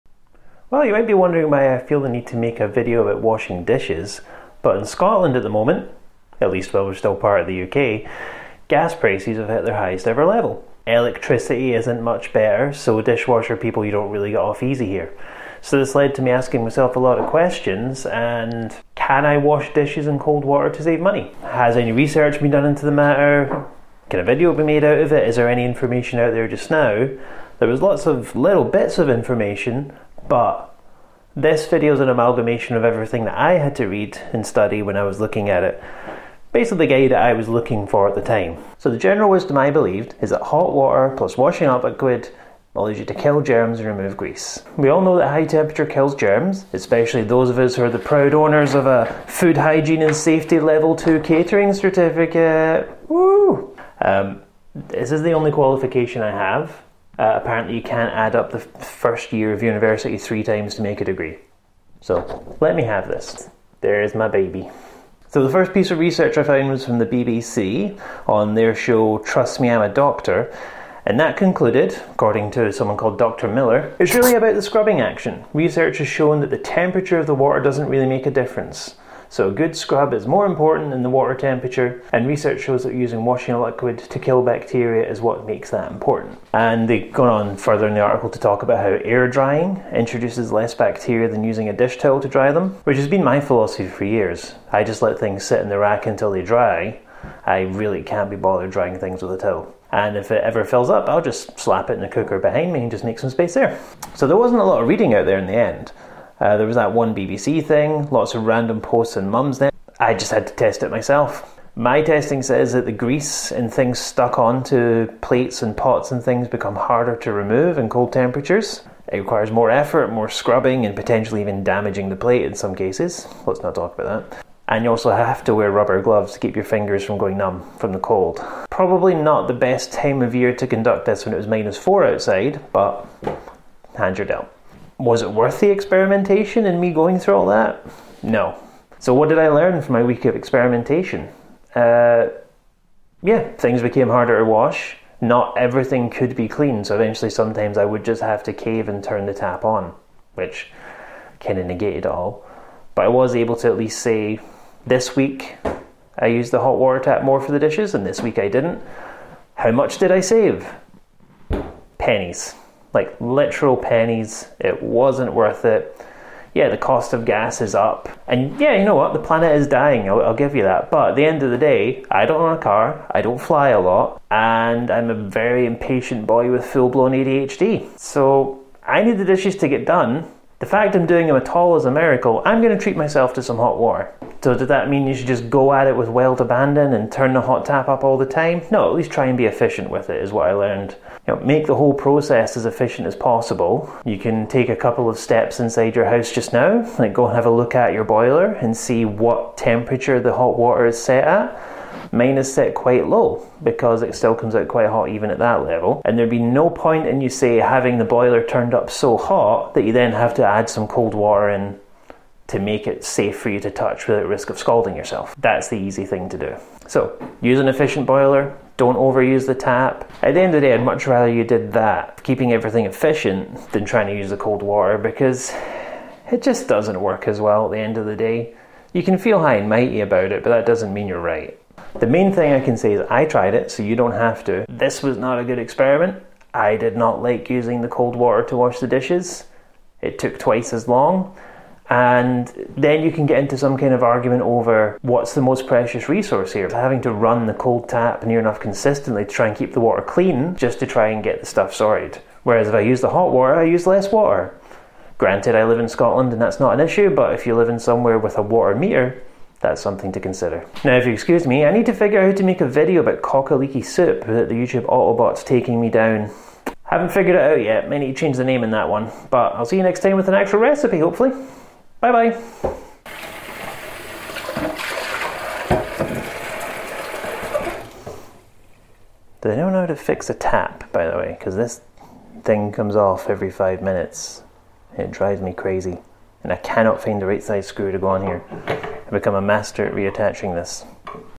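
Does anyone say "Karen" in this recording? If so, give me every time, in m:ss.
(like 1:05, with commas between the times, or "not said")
not said.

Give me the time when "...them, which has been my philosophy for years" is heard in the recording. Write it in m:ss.
1:32.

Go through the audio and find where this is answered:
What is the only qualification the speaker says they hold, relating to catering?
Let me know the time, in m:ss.
0:49.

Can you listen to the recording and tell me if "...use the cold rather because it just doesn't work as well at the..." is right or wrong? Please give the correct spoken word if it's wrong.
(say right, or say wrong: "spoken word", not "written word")
wrong: "water", not "rather".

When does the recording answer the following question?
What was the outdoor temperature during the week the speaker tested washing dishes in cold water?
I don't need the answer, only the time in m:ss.
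2:11.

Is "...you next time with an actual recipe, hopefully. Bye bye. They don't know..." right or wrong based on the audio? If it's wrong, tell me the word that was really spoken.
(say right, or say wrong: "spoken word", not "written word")
right.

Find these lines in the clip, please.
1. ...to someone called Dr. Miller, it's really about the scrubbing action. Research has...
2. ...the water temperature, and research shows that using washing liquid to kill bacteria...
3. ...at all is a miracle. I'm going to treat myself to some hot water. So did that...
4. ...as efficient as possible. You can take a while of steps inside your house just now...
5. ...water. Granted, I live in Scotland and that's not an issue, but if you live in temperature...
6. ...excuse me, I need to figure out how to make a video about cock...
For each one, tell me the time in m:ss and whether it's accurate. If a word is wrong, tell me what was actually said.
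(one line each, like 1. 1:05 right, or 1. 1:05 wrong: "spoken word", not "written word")
1. 1:12 right
2. 1:21 right
3. 3:01 right
4. 3:12 wrong: "couple", not "while"
5. 4:14 wrong: "somewhere", not "temperature"
6. 4:21 right.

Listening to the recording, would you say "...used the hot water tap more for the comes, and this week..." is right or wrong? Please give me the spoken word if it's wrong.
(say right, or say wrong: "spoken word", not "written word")
wrong: "dishes", not "comes".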